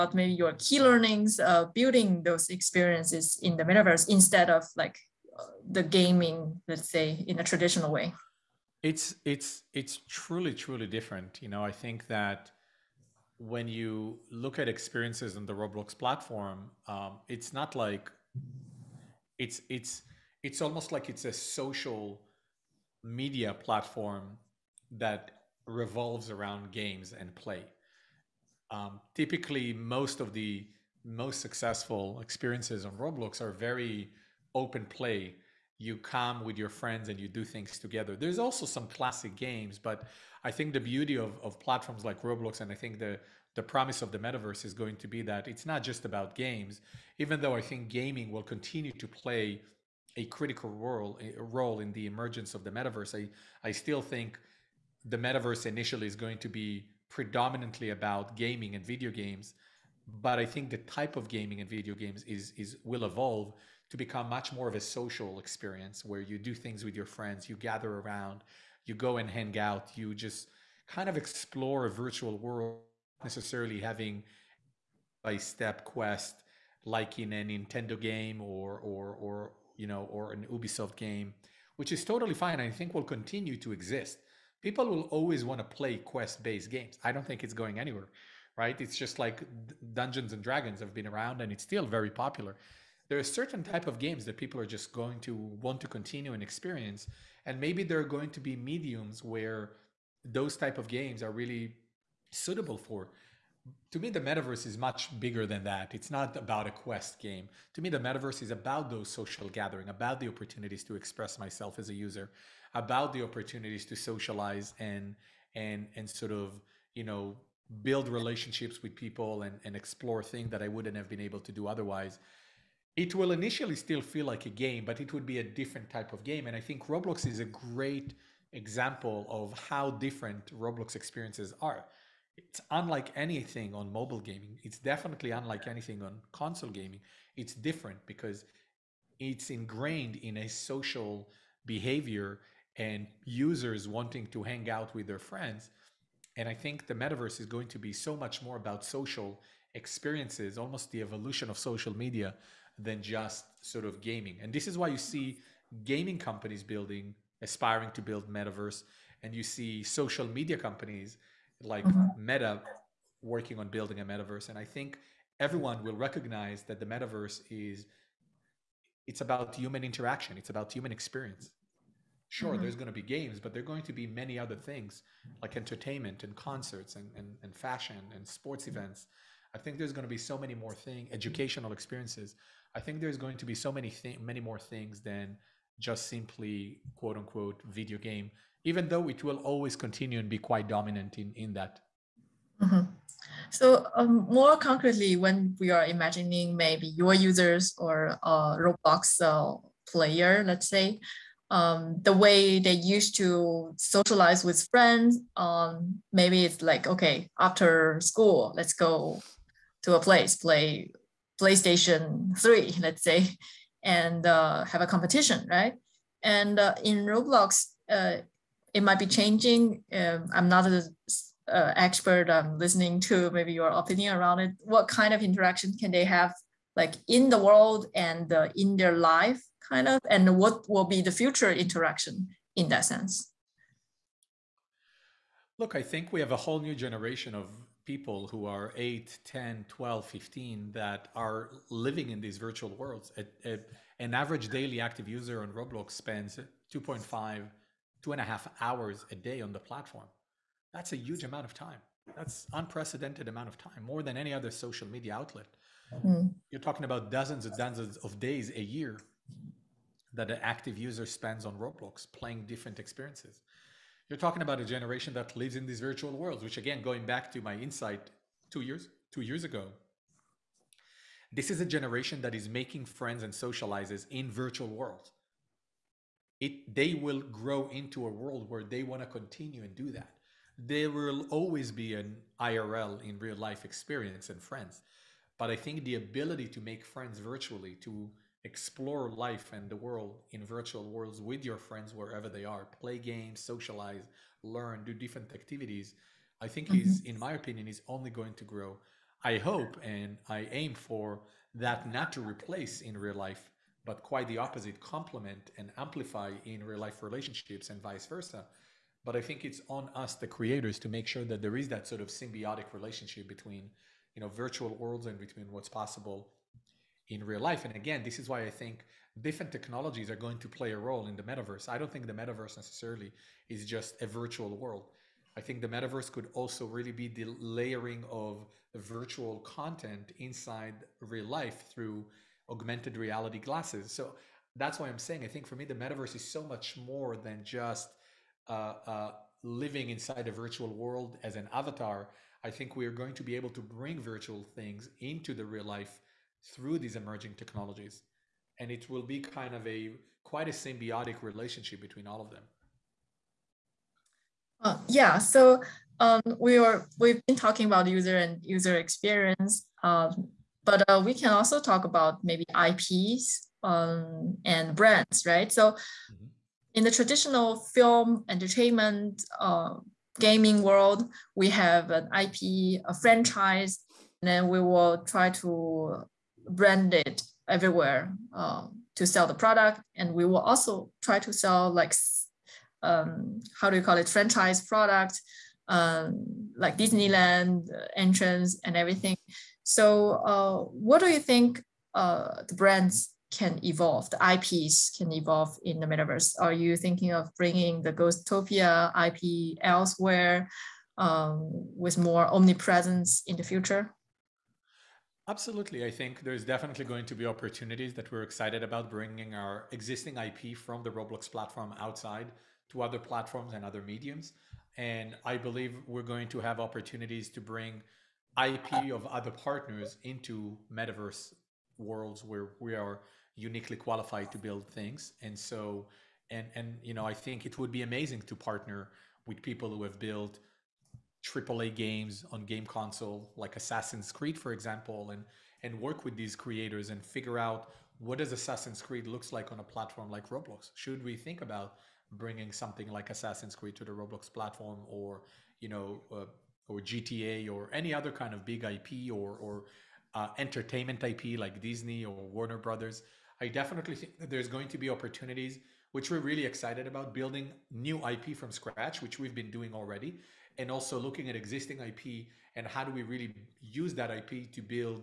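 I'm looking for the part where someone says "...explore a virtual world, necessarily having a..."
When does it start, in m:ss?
1:11.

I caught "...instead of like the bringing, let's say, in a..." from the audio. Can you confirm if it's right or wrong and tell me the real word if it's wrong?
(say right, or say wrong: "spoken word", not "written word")
wrong: "gaming", not "bringing".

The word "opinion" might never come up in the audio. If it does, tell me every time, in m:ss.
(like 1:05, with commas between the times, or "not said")
3:43, 4:57.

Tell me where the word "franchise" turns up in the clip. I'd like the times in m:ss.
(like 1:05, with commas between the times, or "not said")
6:12, 6:24.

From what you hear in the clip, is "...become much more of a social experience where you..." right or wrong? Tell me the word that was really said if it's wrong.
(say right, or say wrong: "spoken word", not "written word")
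right.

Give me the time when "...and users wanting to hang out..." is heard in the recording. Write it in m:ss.
2:22.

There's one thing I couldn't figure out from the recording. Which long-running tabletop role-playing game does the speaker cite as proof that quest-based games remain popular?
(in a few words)
Dungeons and Dragons.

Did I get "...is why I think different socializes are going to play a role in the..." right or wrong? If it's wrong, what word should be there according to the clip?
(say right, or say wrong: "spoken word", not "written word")
wrong: "technologies", not "socializes".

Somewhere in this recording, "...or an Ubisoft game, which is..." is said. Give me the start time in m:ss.
1:20.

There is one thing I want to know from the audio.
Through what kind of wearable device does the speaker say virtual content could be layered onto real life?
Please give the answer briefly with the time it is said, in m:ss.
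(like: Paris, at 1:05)
augmented reality glasses, at 5:32.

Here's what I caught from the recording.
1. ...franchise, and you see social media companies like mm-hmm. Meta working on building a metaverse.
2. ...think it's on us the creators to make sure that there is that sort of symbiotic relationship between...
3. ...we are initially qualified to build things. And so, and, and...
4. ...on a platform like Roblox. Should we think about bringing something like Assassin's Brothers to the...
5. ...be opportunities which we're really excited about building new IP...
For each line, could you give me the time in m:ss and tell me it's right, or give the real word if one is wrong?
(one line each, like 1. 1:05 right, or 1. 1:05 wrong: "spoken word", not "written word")
1. 2:38 wrong: "metaverse", not "franchise"
2. 5:09 right
3. 7:02 wrong: "uniquely", not "initially"
4. 7:19 wrong: "Creed", not "Brothers"
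5. 7:34 right.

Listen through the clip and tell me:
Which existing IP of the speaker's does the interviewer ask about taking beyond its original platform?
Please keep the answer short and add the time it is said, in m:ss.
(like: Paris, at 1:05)
Ghostopia, at 6:37.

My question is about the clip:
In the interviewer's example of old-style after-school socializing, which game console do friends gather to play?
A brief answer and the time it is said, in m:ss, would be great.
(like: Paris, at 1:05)
PlayStation 3, at 3:31.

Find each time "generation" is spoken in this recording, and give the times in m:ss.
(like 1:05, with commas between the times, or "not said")
3:56, 4:24, 4:31.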